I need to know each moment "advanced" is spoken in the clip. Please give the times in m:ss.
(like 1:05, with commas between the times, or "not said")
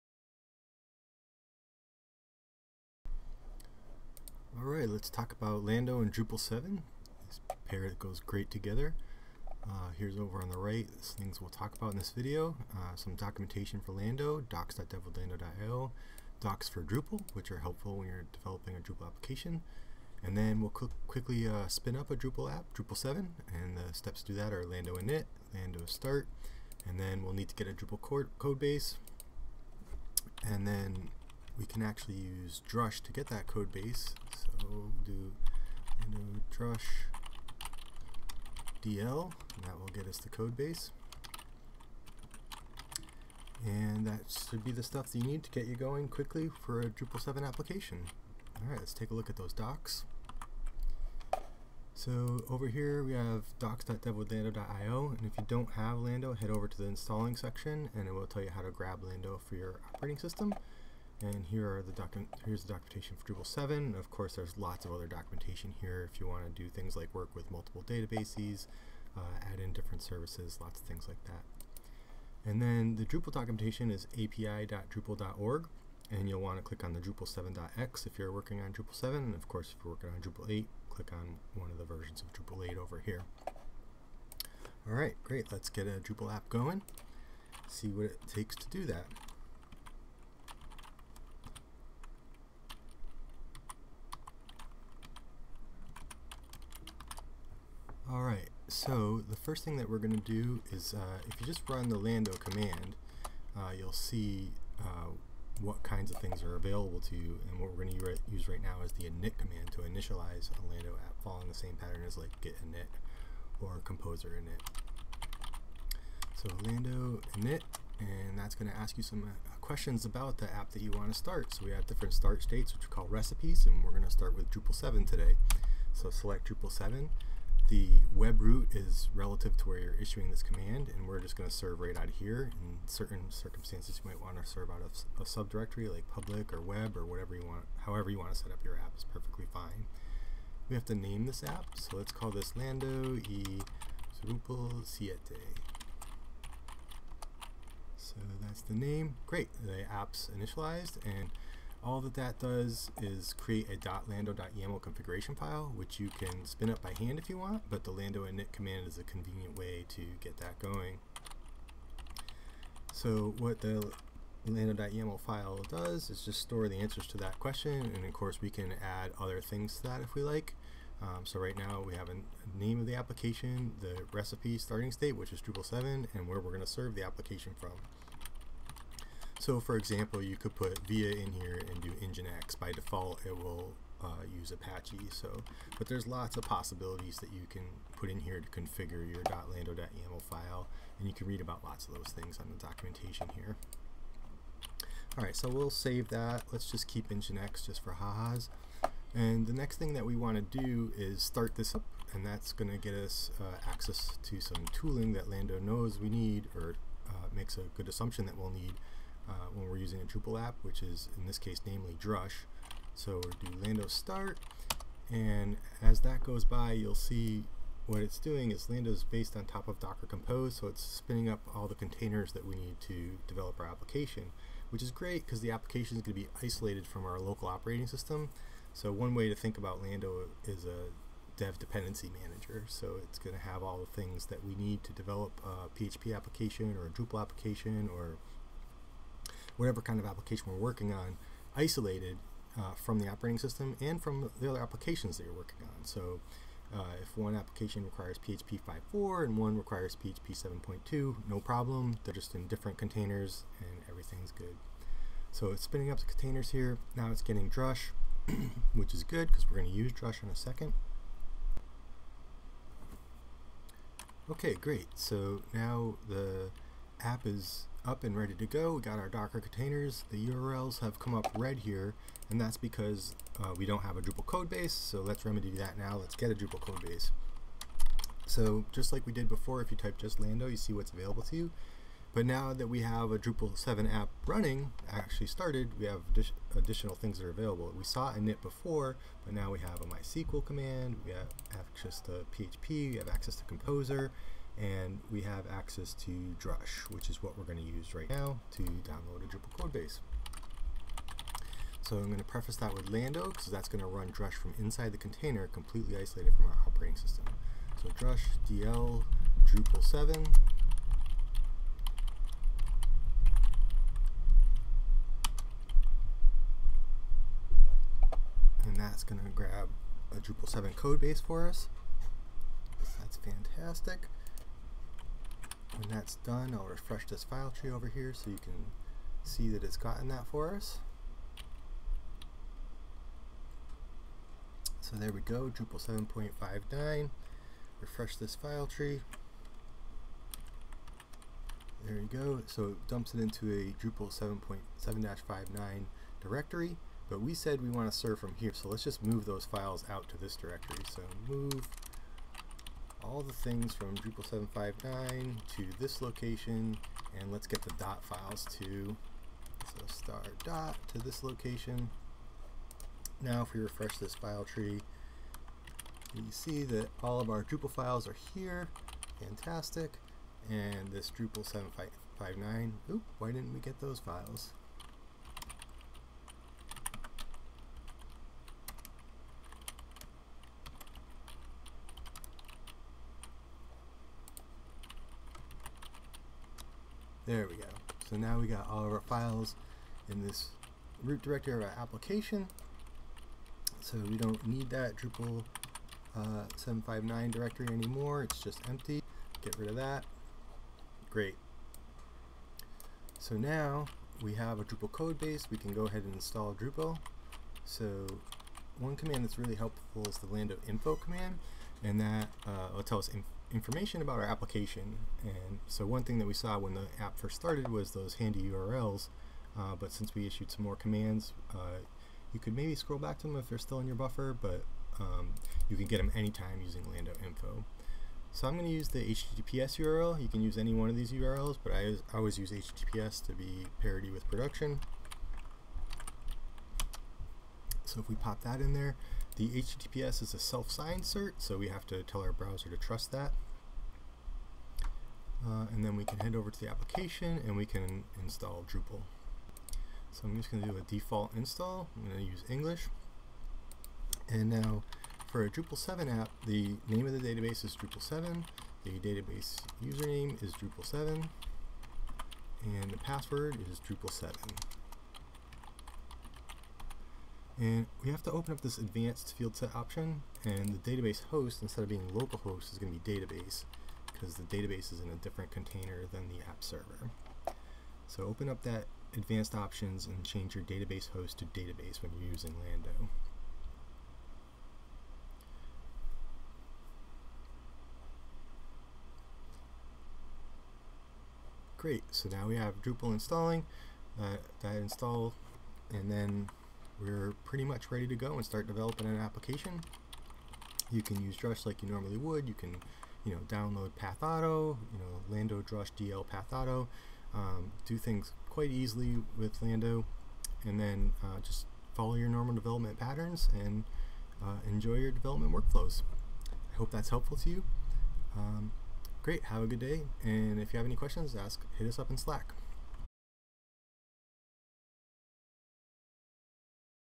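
7:48, 7:59.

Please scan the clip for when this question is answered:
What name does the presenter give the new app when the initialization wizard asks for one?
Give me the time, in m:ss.
2:22.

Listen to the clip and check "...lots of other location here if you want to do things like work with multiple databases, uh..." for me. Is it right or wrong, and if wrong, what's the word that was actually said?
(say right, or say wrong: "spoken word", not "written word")
wrong: "documentation", not "location".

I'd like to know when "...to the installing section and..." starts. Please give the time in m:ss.
0:56.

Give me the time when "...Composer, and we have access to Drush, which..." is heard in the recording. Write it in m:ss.
4:53.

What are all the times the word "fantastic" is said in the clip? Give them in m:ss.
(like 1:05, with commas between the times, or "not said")
5:23, 6:09.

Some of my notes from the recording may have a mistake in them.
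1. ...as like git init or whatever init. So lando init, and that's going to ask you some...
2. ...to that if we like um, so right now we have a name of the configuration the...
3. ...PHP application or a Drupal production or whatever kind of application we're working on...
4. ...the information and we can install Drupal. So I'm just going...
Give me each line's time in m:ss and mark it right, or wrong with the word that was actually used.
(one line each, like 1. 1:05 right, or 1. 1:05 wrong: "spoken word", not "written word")
1. 1:52 wrong: "composer", not "whatever"
2. 2:49 wrong: "application", not "configuration"
3. 3:55 wrong: "application", not "production"
4. 7:26 wrong: "application", not "information".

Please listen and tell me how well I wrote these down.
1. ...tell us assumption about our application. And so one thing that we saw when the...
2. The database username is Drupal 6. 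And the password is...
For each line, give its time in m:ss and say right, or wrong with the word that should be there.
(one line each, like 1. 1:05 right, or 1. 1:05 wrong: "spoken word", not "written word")
1. 6:52 wrong: "information", not "assumption"
2. 7:38 wrong: "7", not "6".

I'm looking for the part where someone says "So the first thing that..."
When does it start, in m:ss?
1:38.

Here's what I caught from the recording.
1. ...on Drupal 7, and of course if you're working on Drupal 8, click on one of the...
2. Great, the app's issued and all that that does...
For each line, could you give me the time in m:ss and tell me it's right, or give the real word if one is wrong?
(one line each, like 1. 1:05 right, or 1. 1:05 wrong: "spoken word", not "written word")
1. 1:18 right
2. 2:29 wrong: "initialized", not "issued".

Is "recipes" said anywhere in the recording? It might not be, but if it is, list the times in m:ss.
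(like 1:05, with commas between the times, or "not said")
2:03, 2:54.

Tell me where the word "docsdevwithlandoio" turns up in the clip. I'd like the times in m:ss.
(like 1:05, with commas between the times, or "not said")
0:14, 0:53.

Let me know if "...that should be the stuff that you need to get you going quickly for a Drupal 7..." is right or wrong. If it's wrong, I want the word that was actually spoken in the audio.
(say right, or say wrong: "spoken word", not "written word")
right.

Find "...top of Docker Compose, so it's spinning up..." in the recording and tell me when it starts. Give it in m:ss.
3:39.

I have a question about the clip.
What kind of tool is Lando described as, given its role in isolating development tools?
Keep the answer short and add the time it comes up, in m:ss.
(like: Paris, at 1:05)
dev dependency manager, at 3:51.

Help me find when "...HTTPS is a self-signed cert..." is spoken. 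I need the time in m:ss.
7:19.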